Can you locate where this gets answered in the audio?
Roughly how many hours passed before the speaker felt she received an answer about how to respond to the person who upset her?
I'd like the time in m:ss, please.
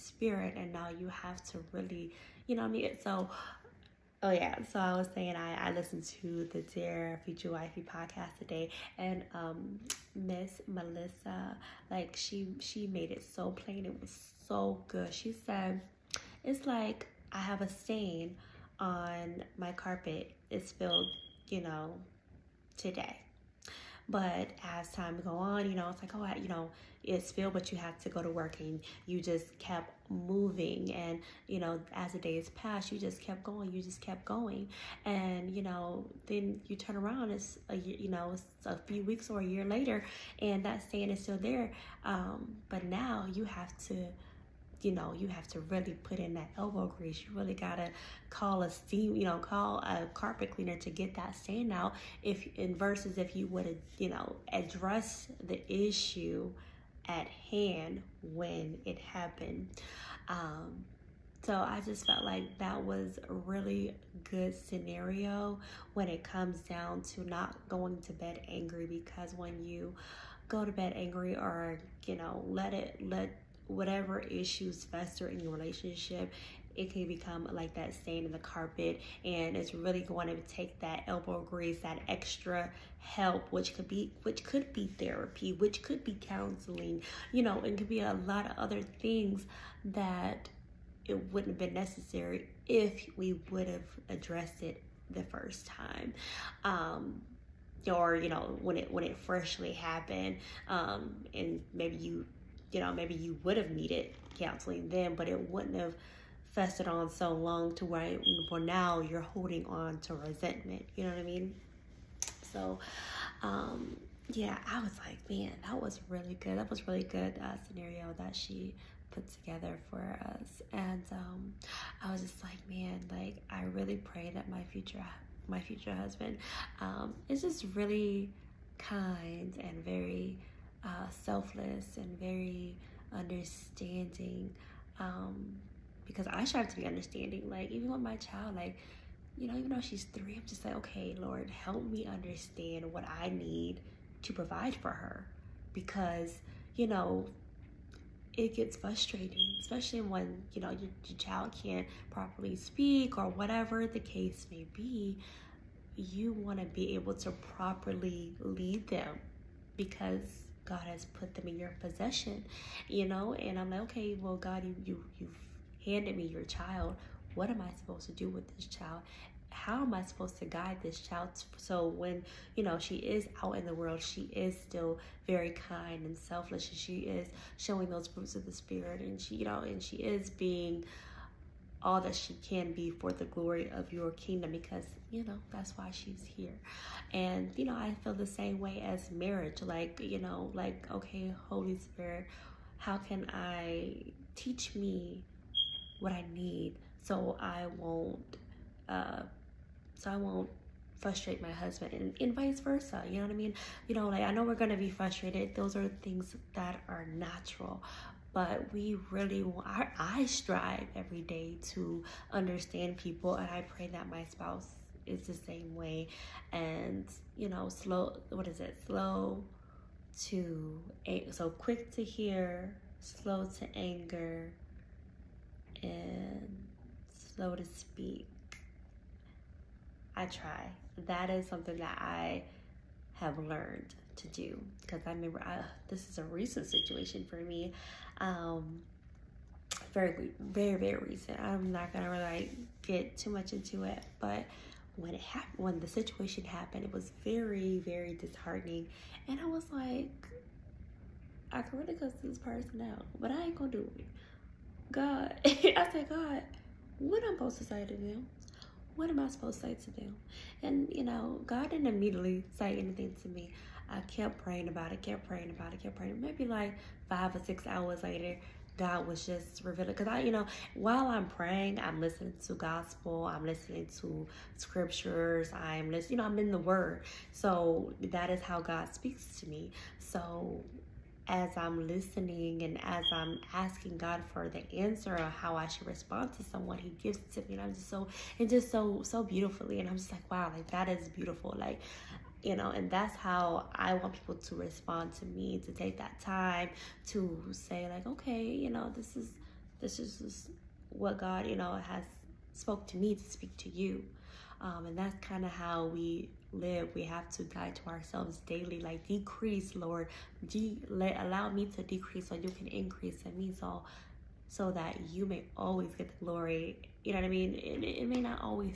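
4:27.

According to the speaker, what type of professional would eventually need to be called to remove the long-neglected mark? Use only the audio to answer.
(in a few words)
carpet cleaner.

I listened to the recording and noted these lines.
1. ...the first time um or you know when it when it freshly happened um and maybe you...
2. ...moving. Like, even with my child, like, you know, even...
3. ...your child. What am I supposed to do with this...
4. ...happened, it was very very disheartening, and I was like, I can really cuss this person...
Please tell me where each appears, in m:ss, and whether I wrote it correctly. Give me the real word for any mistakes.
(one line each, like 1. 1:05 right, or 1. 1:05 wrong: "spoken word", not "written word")
1. 1:35 right
2. 2:16 wrong: "understanding", not "moving"
3. 2:46 right
4. 4:06 right.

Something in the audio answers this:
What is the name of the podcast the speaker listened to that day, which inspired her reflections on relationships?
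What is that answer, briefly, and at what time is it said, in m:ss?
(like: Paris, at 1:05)
Dear Future Wifey, at 0:06.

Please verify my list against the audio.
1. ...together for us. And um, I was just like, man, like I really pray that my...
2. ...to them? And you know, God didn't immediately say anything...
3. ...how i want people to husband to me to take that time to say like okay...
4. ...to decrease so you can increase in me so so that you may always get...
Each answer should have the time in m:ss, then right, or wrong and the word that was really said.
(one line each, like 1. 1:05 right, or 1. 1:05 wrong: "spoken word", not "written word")
1. 1:59 right
2. 4:19 right
3. 4:53 wrong: "respond", not "husband"
4. 5:11 right.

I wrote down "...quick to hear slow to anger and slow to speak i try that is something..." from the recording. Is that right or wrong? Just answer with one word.
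right.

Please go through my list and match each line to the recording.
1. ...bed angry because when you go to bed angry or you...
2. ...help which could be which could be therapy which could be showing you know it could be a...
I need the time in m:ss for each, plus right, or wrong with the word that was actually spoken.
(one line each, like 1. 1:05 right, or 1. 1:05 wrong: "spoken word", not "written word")
1. 1:08 right
2. 1:22 wrong: "counseling", not "showing".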